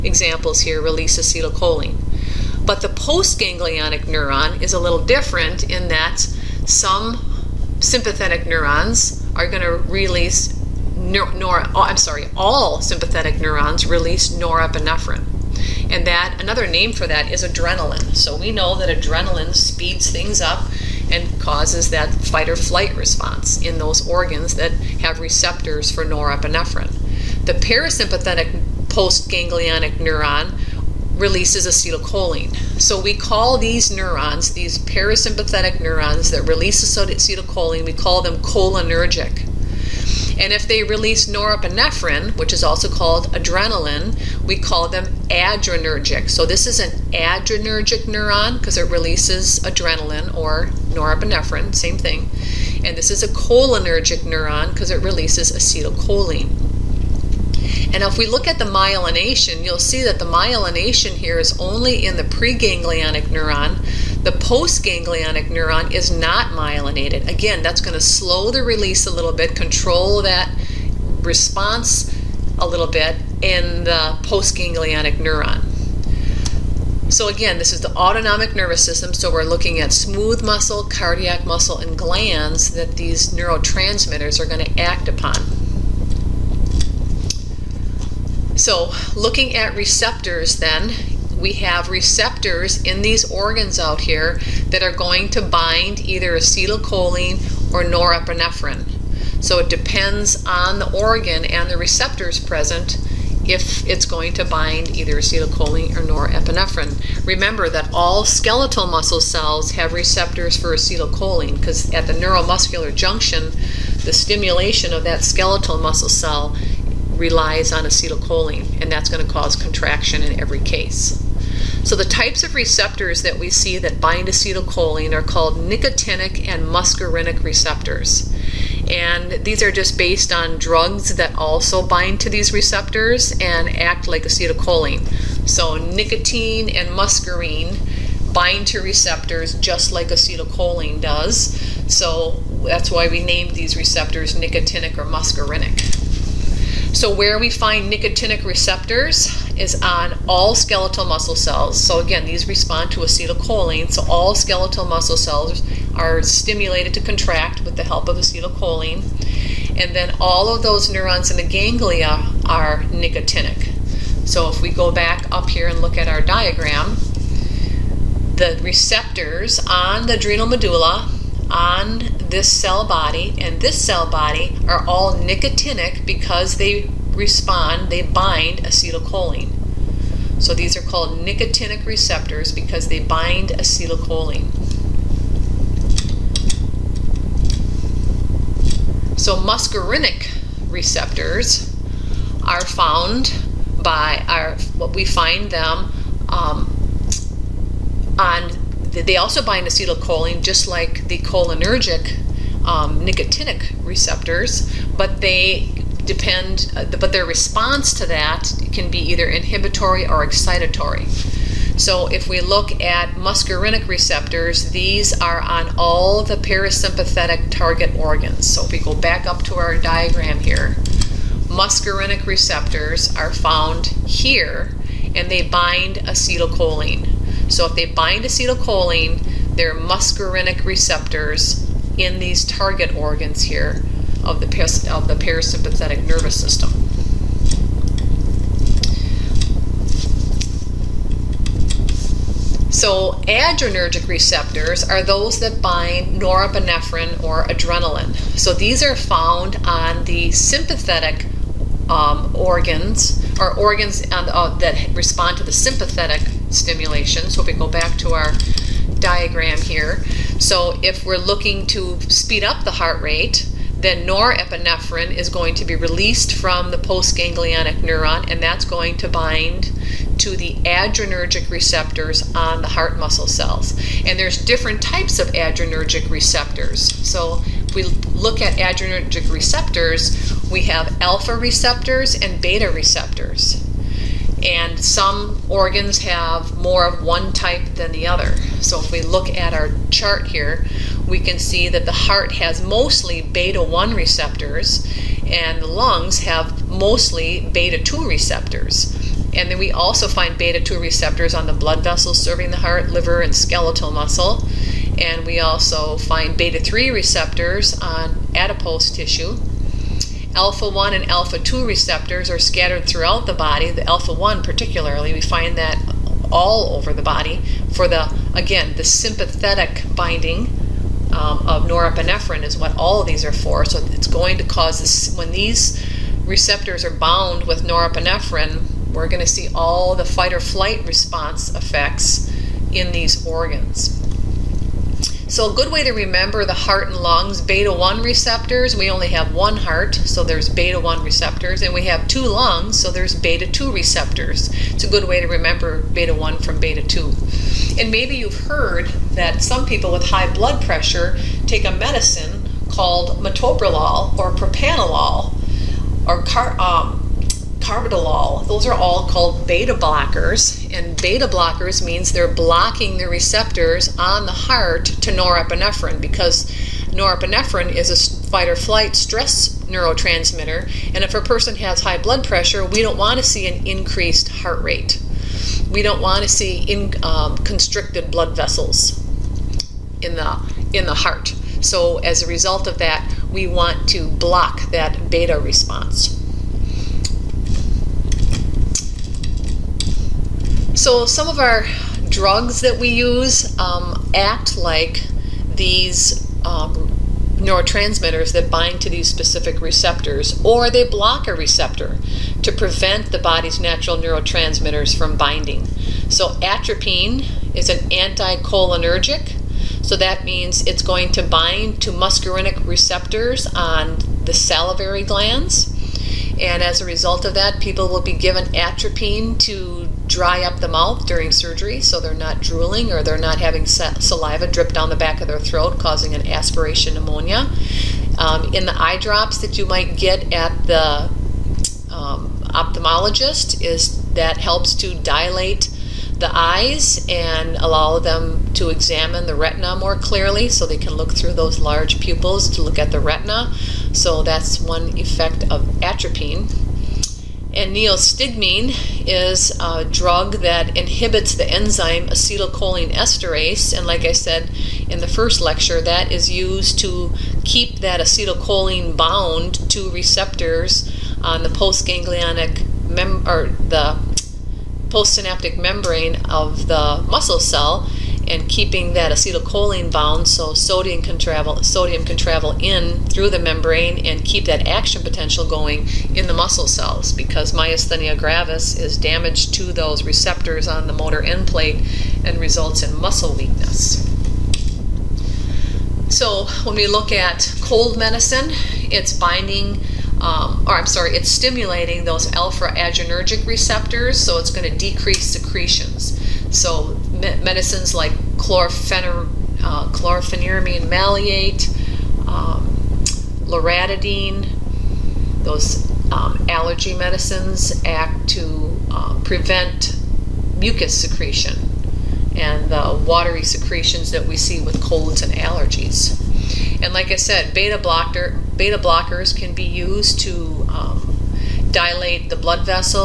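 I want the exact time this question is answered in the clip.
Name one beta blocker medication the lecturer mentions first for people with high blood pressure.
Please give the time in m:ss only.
5:53.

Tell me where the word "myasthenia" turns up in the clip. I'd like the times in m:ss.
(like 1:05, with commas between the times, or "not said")
7:57.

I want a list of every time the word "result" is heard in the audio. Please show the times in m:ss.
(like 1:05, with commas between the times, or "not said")
6:22, 6:56, 8:02.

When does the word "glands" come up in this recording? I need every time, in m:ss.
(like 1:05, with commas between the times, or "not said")
1:21, 6:55.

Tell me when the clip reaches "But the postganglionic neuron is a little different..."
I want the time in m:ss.
0:02.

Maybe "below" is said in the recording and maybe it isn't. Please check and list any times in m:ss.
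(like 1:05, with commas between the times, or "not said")
not said.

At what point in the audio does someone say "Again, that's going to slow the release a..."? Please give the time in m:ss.
1:07.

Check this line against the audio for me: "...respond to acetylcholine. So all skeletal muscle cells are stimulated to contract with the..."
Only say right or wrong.
right.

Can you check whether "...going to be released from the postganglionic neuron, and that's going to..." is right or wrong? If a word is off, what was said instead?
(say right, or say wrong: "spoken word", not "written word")
right.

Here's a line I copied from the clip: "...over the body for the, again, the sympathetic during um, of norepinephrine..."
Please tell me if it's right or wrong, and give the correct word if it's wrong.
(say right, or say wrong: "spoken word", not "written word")
wrong: "binding", not "during".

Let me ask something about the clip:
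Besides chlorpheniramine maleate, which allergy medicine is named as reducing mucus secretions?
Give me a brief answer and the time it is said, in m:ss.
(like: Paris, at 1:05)
Loratadine, at 8:23.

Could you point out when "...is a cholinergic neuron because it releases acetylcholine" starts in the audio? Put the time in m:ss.
0:53.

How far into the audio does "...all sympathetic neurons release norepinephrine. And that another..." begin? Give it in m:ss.
0:12.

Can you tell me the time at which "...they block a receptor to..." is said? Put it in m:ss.
6:40.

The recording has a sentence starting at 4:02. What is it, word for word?
So adrenergic receptors are those that bind norepinephrine or adrenaline.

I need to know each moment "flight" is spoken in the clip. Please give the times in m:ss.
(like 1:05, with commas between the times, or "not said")
0:22, 5:30, 6:08.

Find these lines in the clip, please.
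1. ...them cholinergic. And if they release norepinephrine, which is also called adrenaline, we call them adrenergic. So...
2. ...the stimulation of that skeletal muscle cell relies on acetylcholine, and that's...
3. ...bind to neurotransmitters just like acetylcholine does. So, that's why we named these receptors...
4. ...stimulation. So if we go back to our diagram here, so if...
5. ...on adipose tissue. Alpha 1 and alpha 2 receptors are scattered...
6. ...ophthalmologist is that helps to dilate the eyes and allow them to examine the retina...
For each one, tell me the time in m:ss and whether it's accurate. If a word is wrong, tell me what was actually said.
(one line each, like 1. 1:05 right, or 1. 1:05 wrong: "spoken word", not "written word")
1. 0:38 right
2. 1:54 right
3. 2:18 wrong: "receptors", not "neurotransmitters"
4. 4:16 right
5. 5:07 right
6. 7:12 right.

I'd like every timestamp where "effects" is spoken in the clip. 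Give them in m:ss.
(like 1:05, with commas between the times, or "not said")
5:31, 7:24.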